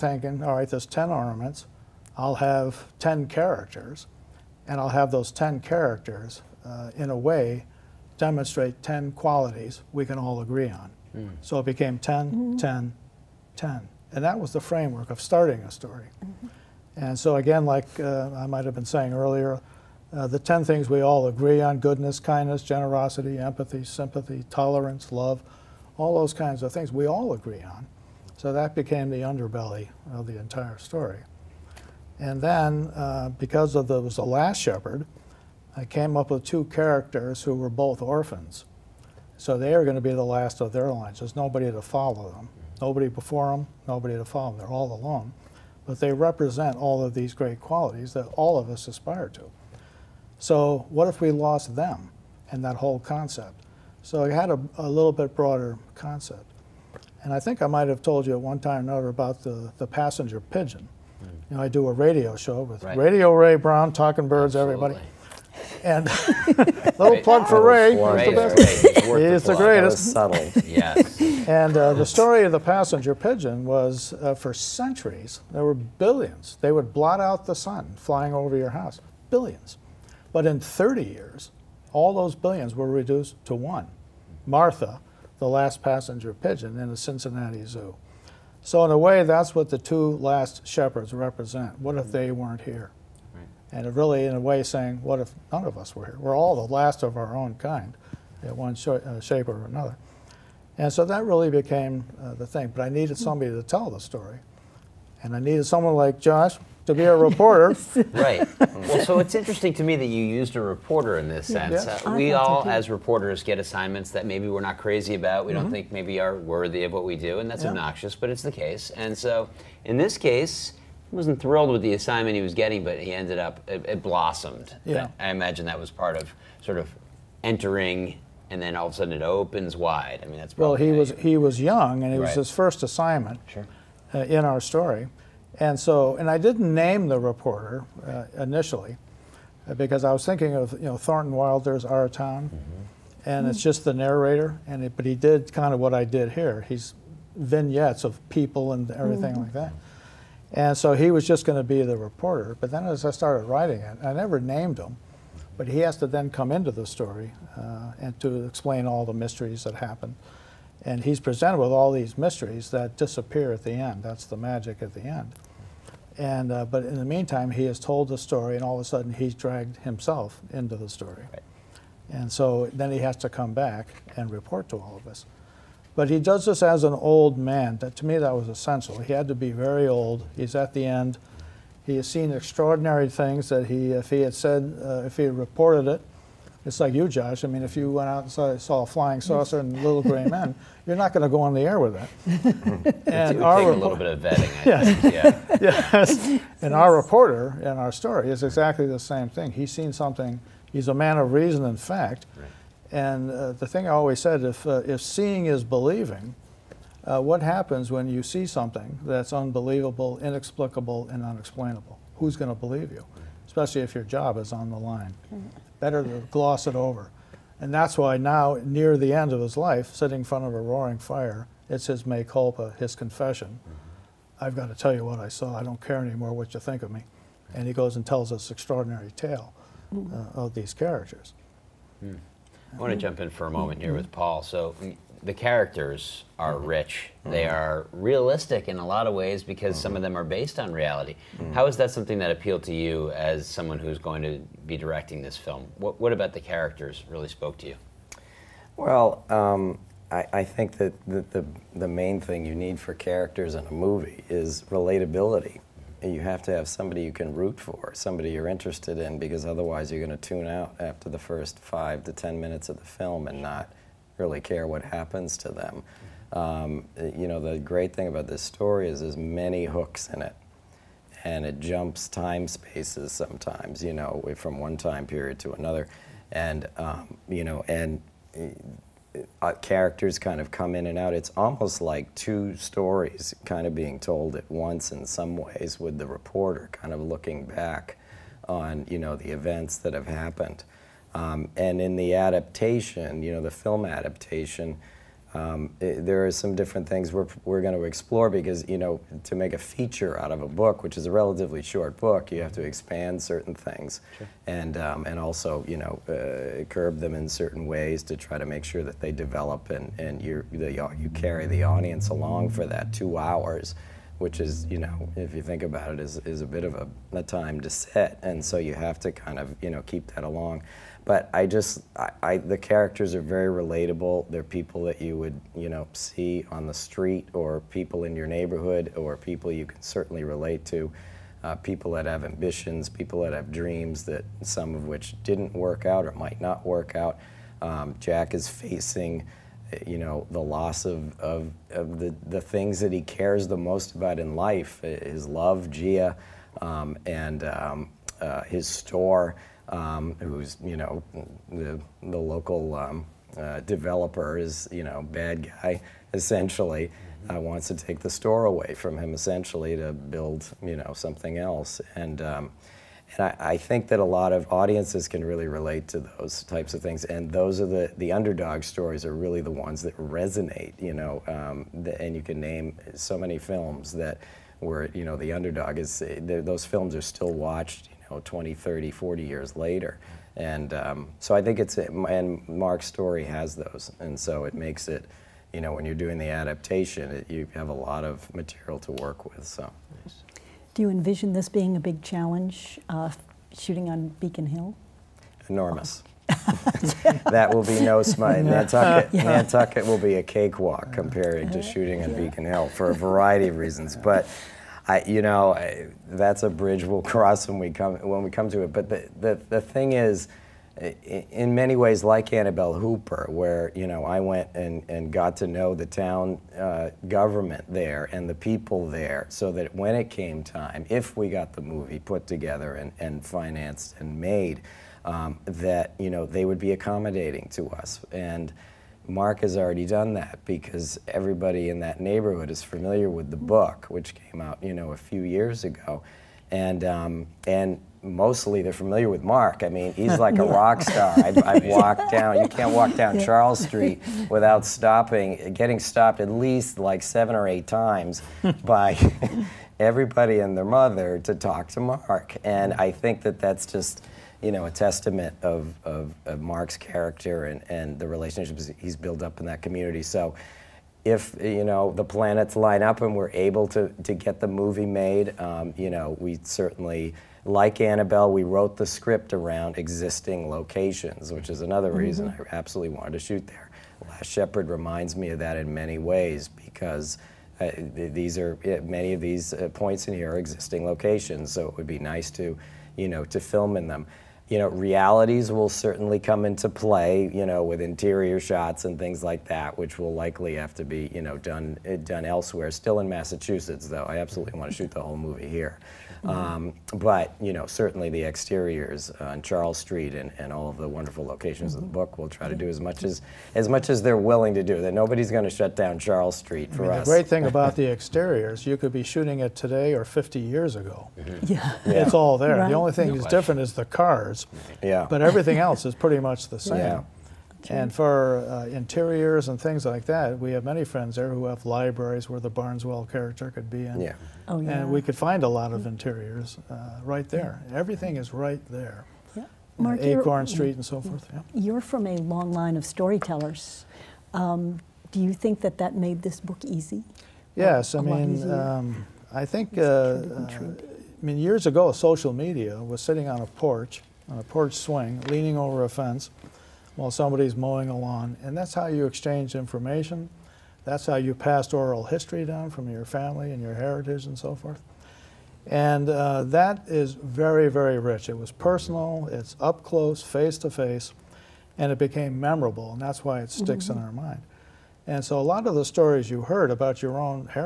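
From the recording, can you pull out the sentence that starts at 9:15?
And uh, that is very, very rich.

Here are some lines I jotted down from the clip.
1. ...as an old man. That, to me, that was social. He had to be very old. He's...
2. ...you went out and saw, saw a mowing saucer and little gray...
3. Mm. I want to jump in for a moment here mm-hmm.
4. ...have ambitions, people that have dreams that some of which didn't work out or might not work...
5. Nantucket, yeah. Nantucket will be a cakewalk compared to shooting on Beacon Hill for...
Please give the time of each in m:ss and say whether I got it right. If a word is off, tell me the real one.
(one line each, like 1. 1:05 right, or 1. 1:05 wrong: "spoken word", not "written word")
1. 2:56 wrong: "essential", not "social"
2. 3:07 wrong: "flying", not "mowing"
3. 3:52 right
4. 5:32 right
5. 6:38 right.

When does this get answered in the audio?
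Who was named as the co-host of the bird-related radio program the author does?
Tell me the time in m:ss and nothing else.
1:03.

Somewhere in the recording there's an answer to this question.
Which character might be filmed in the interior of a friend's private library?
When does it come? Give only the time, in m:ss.
8:42.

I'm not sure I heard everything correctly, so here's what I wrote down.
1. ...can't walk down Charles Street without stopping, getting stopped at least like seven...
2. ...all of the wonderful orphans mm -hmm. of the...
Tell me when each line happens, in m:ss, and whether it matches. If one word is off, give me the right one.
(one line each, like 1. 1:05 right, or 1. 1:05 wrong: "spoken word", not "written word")
1. 7:22 right
2. 8:20 wrong: "locations", not "orphans".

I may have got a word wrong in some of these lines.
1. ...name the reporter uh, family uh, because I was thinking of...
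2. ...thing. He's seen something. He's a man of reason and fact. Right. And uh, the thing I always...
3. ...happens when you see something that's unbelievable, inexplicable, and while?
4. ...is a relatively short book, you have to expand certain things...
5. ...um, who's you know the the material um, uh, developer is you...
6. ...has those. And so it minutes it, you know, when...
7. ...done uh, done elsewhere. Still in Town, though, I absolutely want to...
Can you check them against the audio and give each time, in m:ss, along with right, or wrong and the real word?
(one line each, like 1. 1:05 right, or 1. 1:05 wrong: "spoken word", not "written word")
1. 2:16 wrong: "initially", not "family"
2. 3:19 right
3. 3:27 wrong: "unexplainable", not "while"
4. 5:00 right
5. 5:49 wrong: "local", not "material"
6. 6:23 wrong: "makes", not "minutes"
7. 8:11 wrong: "Massachusetts", not "Town".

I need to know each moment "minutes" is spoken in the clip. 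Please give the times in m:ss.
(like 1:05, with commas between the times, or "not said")
4:22.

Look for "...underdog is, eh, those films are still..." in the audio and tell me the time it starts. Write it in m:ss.
6:15.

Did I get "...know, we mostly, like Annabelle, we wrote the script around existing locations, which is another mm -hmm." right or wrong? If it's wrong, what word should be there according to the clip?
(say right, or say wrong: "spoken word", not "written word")
wrong: "certainly", not "mostly".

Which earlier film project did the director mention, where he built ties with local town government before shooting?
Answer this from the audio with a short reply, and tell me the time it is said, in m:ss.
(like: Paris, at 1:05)
Annabelle Hooper, at 6:52.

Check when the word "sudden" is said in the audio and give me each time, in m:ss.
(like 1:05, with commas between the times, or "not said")
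2:08, 2:48.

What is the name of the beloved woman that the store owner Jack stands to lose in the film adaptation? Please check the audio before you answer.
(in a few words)
Gia.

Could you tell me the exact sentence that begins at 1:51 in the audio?
Uh, we all, as reporters, get assignments that maybe we're not crazy about.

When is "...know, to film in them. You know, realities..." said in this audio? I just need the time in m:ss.
8:03.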